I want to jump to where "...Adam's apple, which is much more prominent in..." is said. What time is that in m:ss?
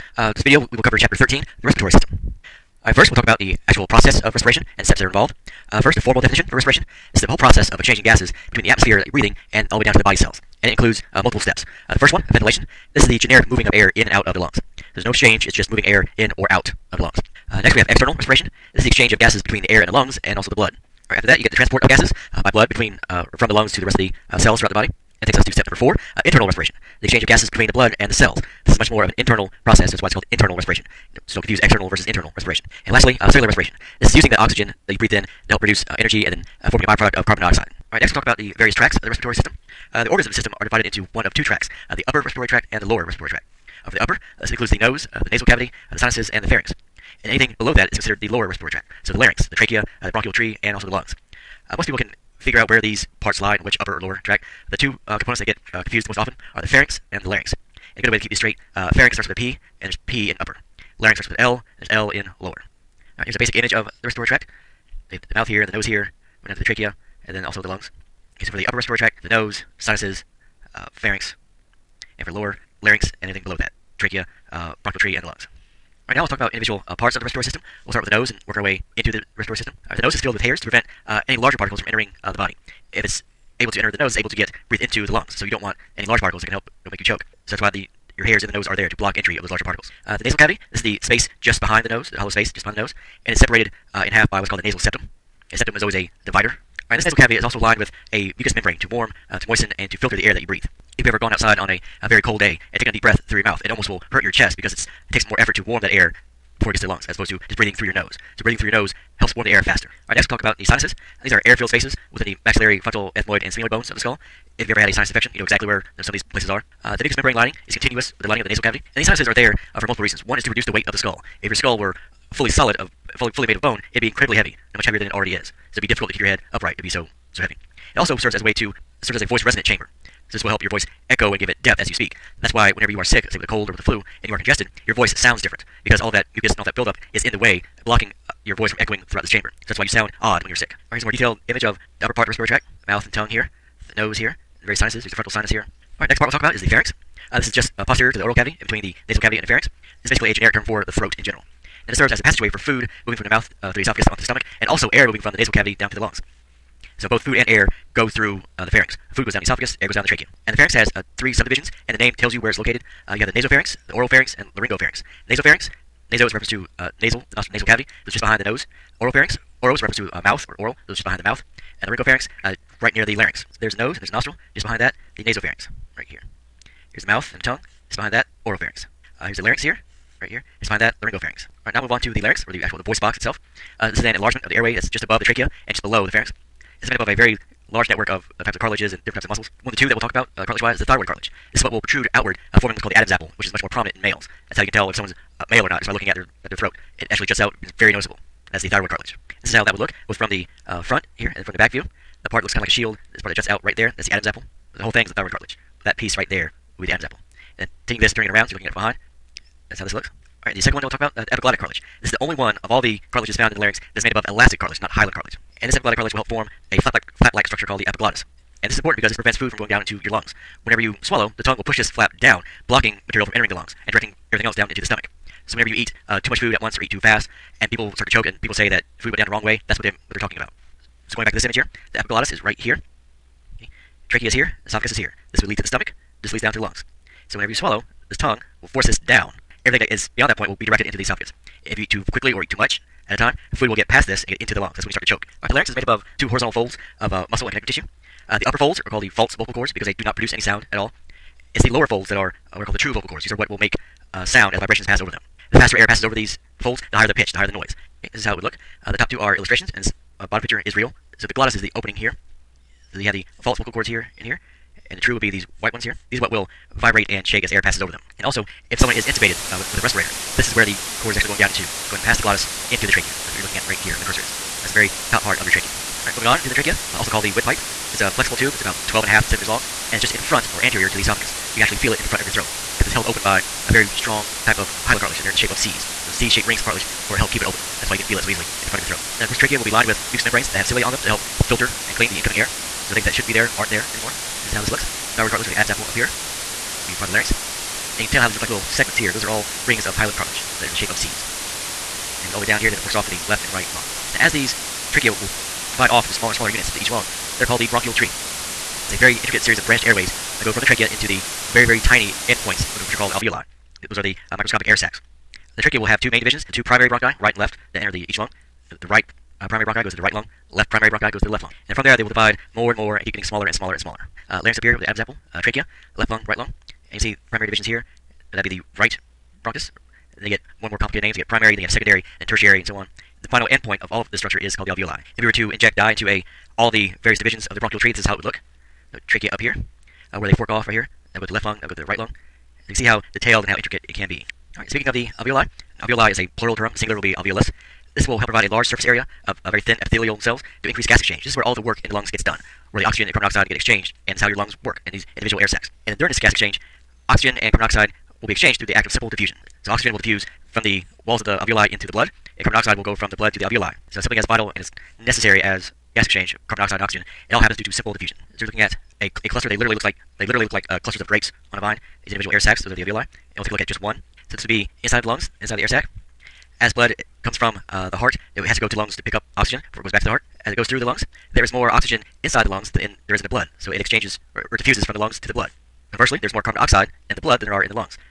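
3:12.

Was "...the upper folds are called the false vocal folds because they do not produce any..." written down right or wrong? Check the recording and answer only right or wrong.
wrong.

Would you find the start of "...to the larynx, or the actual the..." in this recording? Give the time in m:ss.
3:01.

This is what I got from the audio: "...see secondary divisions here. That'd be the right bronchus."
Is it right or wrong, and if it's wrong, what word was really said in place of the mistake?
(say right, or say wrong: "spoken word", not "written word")
wrong: "primary", not "secondary".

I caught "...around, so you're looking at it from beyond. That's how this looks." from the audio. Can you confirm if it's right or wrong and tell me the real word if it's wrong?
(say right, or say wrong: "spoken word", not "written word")
wrong: "behind", not "beyond".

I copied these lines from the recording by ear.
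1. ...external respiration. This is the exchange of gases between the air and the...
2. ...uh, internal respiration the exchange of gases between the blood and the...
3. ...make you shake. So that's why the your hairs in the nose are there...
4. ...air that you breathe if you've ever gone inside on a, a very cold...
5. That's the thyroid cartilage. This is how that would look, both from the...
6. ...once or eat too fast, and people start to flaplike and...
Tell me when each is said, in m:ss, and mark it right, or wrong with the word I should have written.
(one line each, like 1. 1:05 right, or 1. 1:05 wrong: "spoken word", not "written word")
1. 0:17 right
2. 0:26 right
3. 1:26 wrong: "choke", not "shake"
4. 1:40 wrong: "outside", not "inside"
5. 3:18 right
6. 3:46 wrong: "choke", not "flaplike".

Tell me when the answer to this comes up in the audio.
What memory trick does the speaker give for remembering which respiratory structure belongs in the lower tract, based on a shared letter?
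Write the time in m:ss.
1:01.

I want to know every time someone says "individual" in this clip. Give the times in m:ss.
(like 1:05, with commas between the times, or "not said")
1:16, 5:55, 6:12.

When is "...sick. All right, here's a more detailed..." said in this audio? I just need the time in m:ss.
2:20.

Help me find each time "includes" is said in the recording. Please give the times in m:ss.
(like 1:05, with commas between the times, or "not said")
0:10, 0:44.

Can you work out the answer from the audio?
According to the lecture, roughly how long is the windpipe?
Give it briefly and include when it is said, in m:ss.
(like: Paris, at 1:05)
12.5 centimeters, at 4:38.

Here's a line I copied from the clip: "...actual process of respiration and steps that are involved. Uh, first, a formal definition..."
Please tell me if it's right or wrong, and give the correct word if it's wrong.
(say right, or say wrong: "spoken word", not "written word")
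right.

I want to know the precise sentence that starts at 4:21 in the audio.
So the glottis is the opening here.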